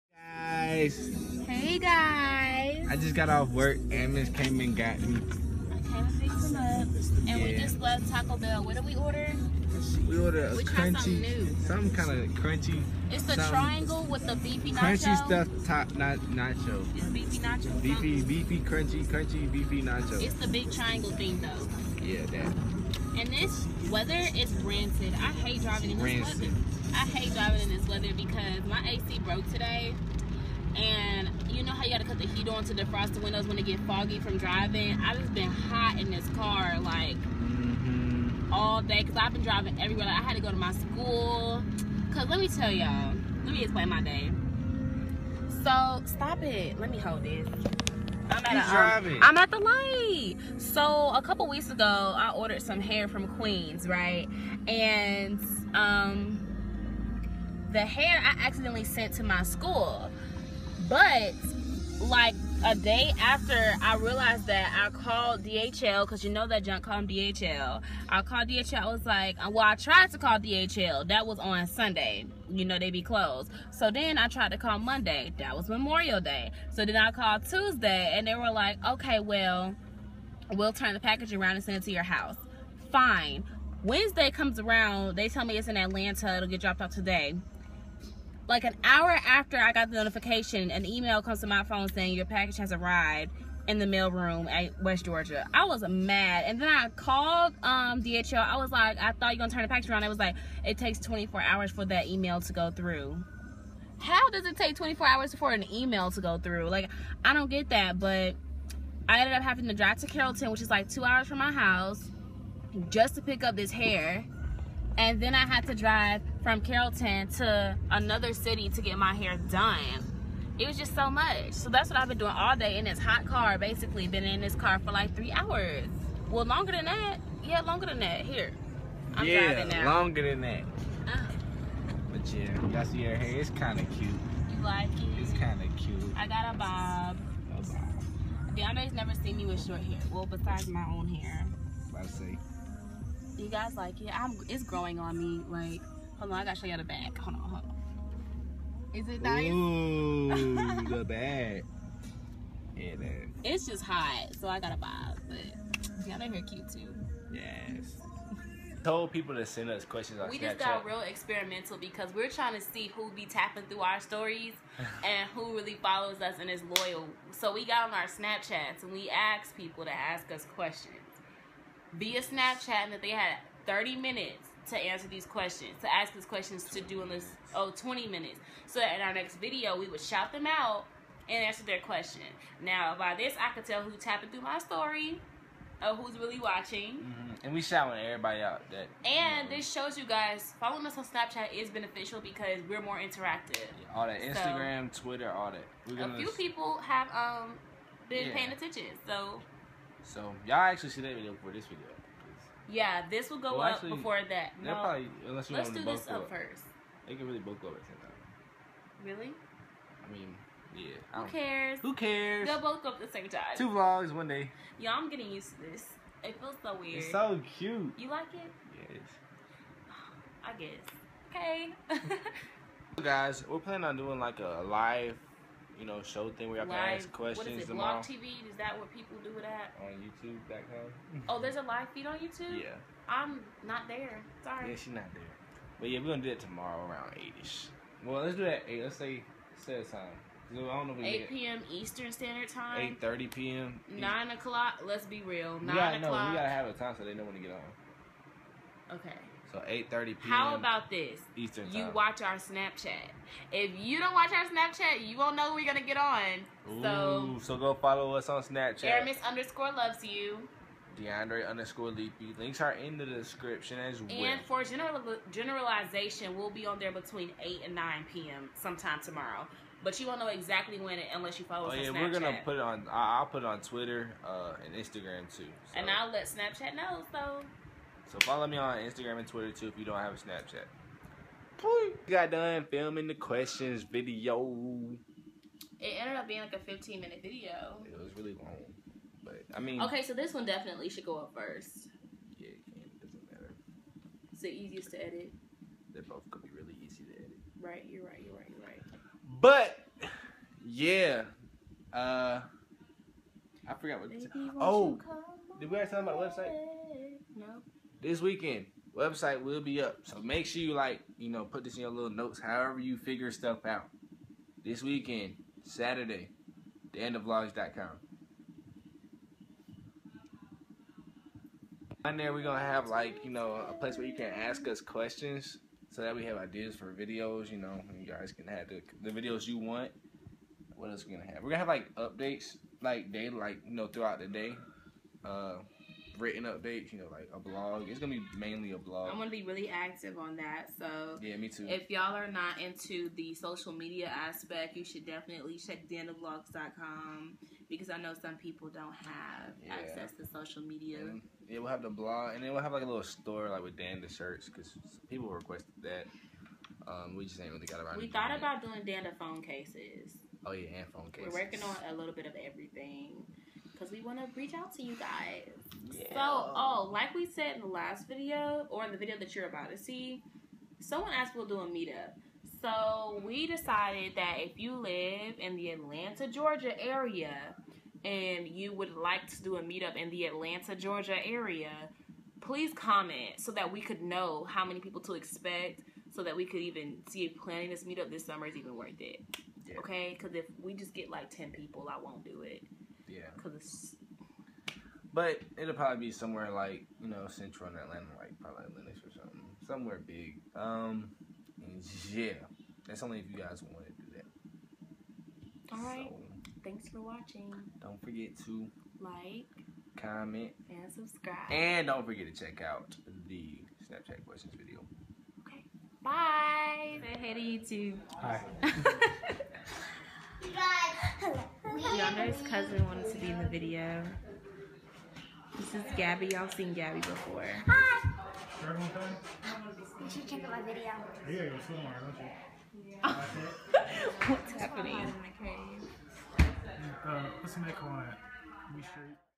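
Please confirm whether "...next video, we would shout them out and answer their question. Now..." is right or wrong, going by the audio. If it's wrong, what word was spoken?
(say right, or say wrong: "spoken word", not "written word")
right.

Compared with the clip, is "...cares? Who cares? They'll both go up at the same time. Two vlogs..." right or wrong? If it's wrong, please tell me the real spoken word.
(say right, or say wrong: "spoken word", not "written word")
right.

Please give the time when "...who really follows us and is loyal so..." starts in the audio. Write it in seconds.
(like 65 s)
165 s.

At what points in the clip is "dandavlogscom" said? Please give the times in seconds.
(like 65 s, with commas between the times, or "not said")
316 s, 345 s.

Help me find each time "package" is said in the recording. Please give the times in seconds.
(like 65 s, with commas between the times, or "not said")
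80 s, 92 s, 99 s.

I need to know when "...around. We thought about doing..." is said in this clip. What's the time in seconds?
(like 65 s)
357 s.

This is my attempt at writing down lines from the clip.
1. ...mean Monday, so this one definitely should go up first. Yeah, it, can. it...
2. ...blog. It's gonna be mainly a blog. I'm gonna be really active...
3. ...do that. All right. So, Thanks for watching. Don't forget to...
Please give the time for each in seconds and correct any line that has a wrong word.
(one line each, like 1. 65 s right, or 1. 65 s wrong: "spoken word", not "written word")
1. 289 s wrong: "Okay", not "Monday"
2. 337 s right
3. 403 s right.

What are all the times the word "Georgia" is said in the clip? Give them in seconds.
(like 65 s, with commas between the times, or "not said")
95 s, 376 s, 380 s.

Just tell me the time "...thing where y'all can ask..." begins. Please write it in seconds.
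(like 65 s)
226 s.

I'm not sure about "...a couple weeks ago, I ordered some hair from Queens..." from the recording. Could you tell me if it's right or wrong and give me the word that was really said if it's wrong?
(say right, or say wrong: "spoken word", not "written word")
right.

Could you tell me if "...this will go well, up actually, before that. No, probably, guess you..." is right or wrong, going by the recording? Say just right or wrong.
wrong.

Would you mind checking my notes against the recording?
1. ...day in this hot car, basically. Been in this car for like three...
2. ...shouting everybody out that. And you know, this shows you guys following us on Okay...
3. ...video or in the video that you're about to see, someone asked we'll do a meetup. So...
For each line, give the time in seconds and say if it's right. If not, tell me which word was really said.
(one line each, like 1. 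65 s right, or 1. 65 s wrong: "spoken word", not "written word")
1. 122 s right
2. 187 s wrong: "Snapchat", not "Okay"
3. 368 s right.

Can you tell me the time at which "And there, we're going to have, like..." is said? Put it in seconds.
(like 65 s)
322 s.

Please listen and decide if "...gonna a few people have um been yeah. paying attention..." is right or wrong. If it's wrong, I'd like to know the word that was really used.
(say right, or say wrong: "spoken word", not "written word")
right.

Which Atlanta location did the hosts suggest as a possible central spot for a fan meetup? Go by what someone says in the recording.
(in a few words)
Lenox.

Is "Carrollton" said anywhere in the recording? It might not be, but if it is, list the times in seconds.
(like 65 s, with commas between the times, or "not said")
110 s, 116 s.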